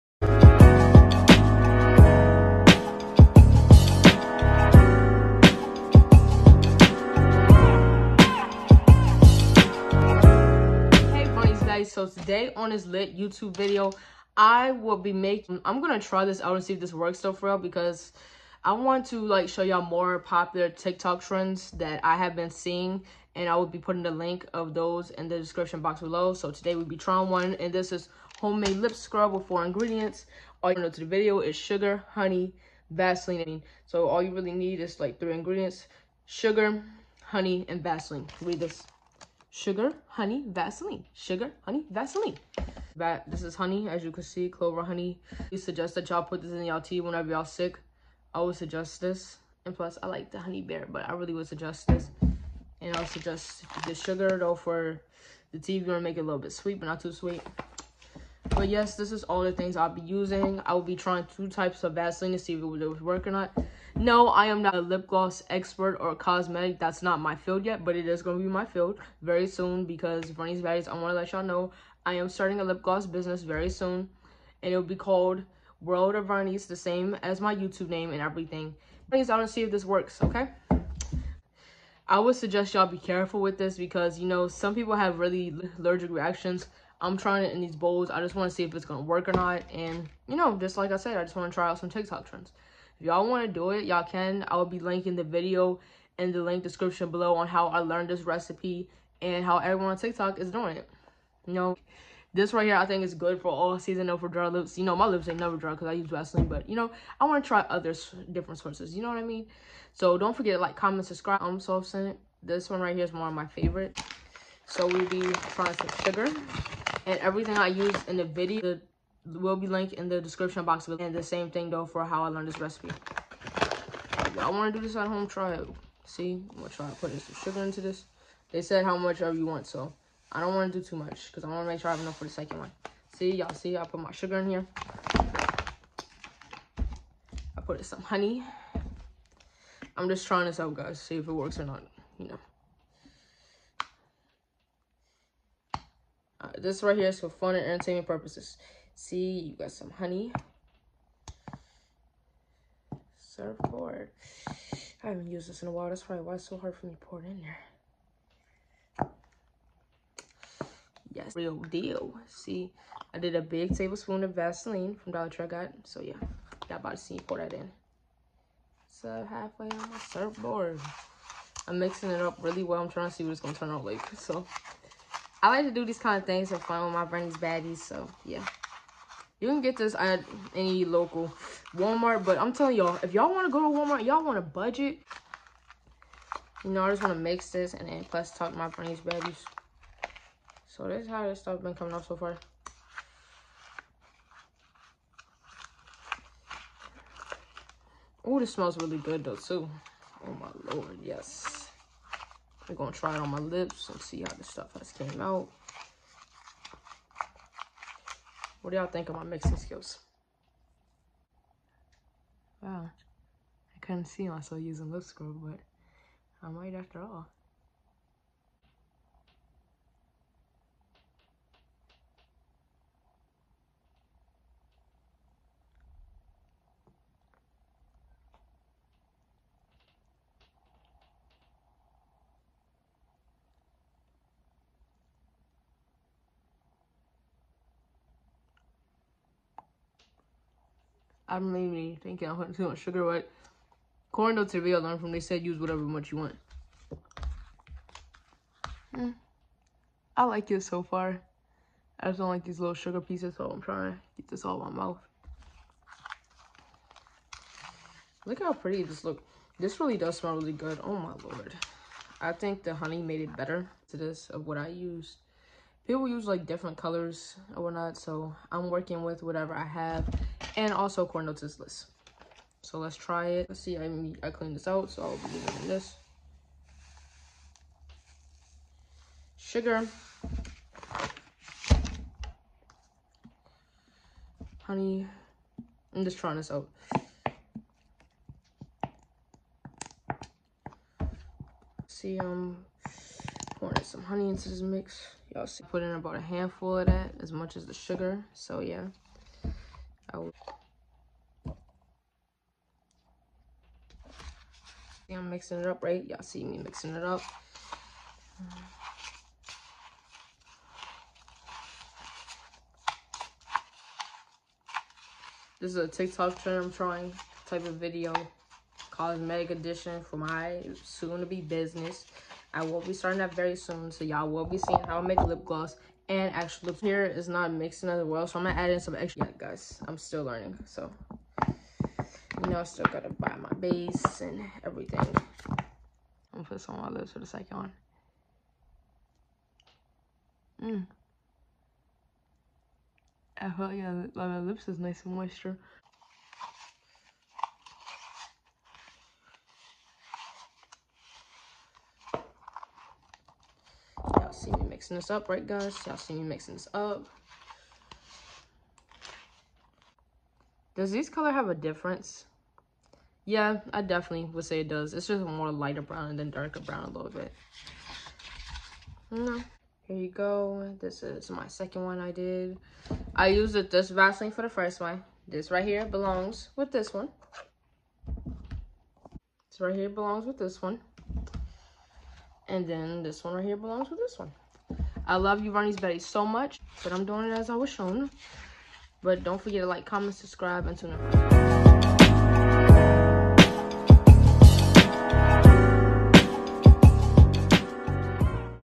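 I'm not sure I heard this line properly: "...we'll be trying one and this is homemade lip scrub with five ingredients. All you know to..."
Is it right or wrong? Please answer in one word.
wrong.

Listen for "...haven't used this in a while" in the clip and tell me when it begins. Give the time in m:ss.
2:35.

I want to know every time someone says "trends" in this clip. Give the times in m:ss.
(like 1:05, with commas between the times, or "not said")
0:21, 1:32, 5:16.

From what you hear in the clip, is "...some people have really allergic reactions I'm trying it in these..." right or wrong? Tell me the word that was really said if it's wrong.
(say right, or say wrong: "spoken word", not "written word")
right.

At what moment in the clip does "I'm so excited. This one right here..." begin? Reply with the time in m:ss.
1:51.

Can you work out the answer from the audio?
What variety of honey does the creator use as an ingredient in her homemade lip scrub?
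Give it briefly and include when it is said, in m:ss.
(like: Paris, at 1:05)
Clover honey, at 0:44.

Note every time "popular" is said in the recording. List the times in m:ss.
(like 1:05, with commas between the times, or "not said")
0:20.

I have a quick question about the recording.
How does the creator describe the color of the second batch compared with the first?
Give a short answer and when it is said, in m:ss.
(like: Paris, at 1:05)
Lighter brown, at 6:05.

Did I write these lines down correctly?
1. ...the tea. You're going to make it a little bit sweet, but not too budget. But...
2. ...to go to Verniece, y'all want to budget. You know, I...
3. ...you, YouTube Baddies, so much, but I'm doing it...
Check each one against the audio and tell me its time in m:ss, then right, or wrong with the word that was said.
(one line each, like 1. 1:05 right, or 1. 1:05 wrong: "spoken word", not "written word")
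1. 0:55 wrong: "sweet", not "budget"
2. 3:03 wrong: "Walmart", not "Verniece"
3. 6:25 wrong: "Verniece", not "YouTube".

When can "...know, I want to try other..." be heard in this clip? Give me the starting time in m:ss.
1:46.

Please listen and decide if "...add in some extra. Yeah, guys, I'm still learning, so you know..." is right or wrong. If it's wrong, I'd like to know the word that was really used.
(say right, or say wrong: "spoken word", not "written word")
right.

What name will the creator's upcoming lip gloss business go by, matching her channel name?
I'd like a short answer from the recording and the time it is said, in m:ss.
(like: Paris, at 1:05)
World of Verniece, at 1:15.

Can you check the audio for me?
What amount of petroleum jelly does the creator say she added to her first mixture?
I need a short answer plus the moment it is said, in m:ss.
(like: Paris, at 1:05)
A big tablespoon, at 2:43.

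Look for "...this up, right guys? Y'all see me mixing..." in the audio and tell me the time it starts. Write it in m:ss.
5:54.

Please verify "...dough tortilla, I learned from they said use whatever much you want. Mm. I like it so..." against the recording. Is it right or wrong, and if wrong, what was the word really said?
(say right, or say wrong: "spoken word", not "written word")
right.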